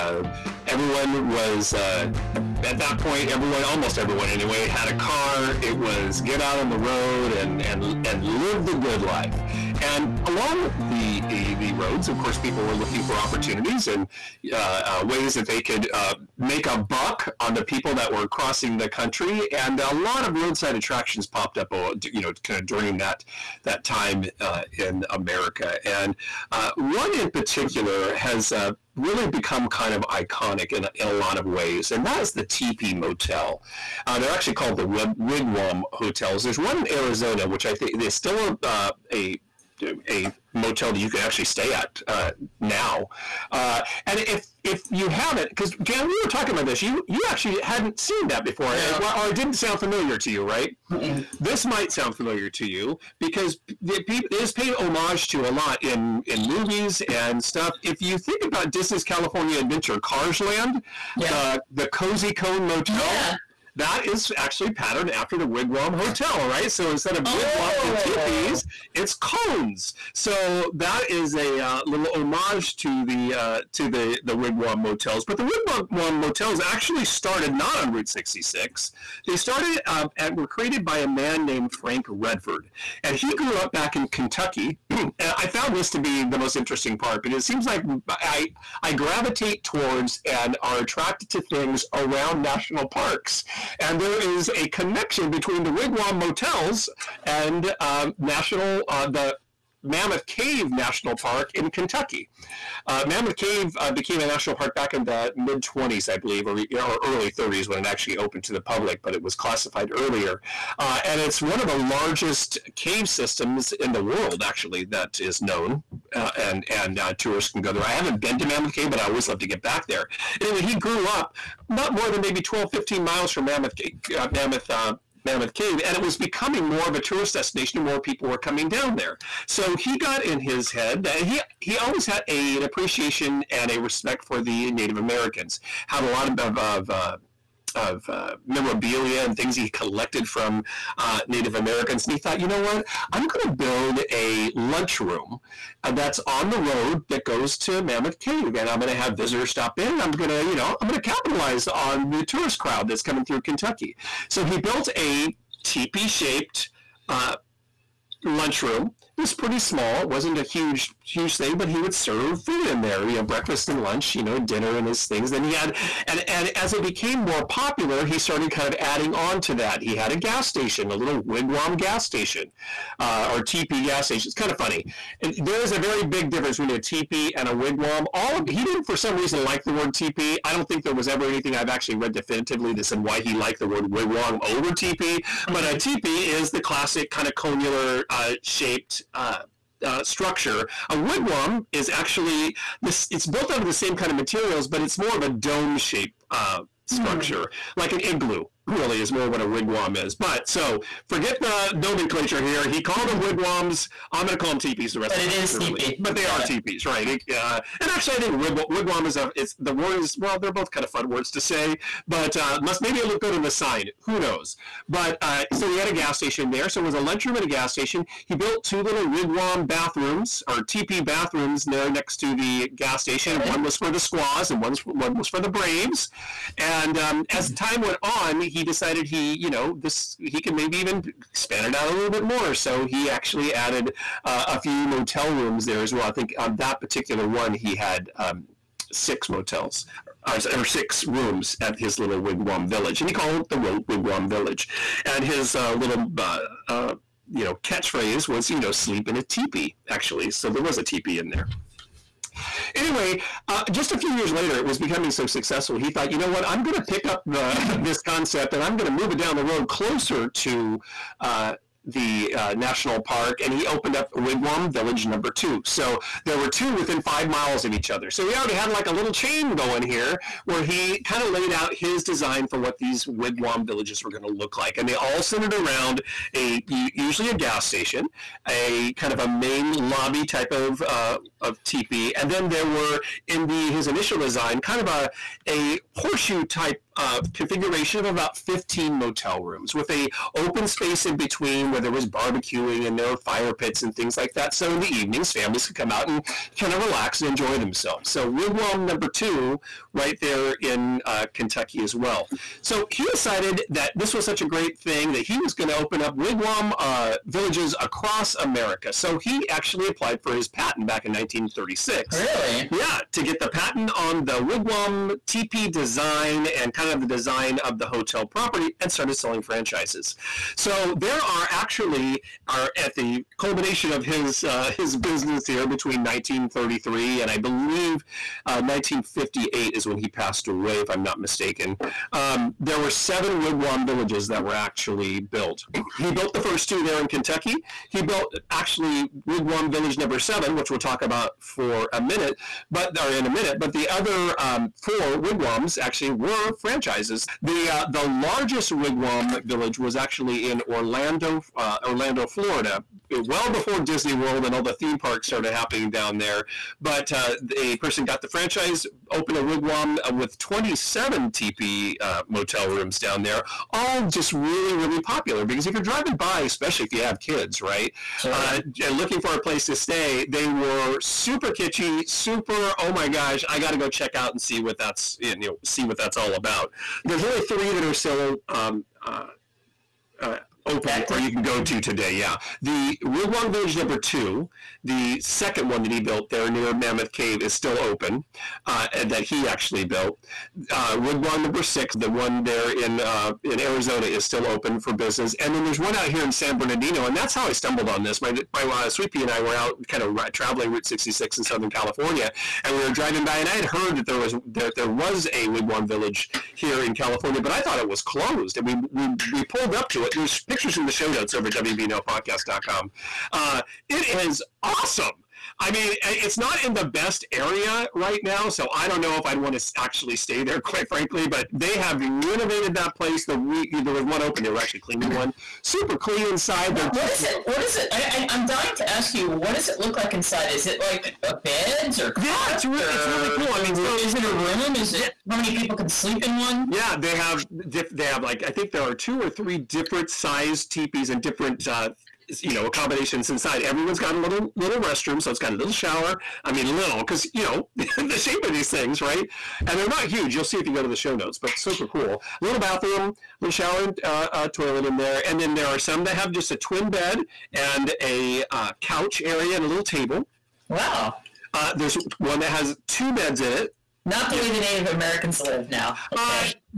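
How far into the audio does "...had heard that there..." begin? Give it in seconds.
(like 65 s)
403 s.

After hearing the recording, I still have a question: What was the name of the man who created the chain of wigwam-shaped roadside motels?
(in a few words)
Frank Redford.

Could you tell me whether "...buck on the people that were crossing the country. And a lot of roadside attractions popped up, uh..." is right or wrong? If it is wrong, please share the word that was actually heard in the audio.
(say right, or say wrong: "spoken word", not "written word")
right.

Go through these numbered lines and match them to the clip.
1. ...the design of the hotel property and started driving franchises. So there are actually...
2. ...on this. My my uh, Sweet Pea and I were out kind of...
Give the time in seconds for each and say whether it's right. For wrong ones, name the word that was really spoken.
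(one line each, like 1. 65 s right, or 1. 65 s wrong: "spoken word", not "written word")
1. 317 s wrong: "selling", not "driving"
2. 397 s right.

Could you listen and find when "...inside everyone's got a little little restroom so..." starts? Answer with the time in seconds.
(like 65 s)
443 s.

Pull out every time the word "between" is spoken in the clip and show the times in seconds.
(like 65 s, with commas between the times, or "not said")
95 s, 176 s, 291 s, 325 s.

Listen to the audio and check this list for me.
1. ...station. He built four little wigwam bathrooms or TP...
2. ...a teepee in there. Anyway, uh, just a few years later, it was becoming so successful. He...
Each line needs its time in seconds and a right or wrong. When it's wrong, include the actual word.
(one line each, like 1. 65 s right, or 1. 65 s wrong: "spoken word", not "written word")
1. 217 s wrong: "two", not "four"
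2. 250 s right.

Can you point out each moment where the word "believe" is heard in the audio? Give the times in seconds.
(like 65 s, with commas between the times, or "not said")
106 s, 327 s.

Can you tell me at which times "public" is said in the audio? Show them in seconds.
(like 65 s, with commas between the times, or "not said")
108 s.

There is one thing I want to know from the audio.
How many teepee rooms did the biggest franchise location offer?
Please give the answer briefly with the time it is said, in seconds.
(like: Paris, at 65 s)
27, at 360 s.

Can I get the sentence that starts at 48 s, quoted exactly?
it, or it didn't sound familiar to you, right?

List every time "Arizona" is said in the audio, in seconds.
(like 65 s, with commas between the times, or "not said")
36 s, 393 s.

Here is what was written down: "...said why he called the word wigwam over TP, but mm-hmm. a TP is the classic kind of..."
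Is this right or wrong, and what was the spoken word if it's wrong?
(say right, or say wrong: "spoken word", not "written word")
wrong: "liked", not "called".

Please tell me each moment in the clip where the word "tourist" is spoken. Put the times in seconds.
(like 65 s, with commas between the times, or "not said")
117 s, 127 s, 152 s.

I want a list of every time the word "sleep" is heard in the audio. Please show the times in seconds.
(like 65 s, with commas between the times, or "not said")
248 s, 435 s.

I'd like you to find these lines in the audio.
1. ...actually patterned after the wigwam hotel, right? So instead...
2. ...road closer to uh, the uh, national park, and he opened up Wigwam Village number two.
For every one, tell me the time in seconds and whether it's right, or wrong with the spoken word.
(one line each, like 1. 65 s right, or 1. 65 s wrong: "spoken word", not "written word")
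1. 64 s right
2. 259 s right.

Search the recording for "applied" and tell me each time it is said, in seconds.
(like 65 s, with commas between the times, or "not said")
309 s.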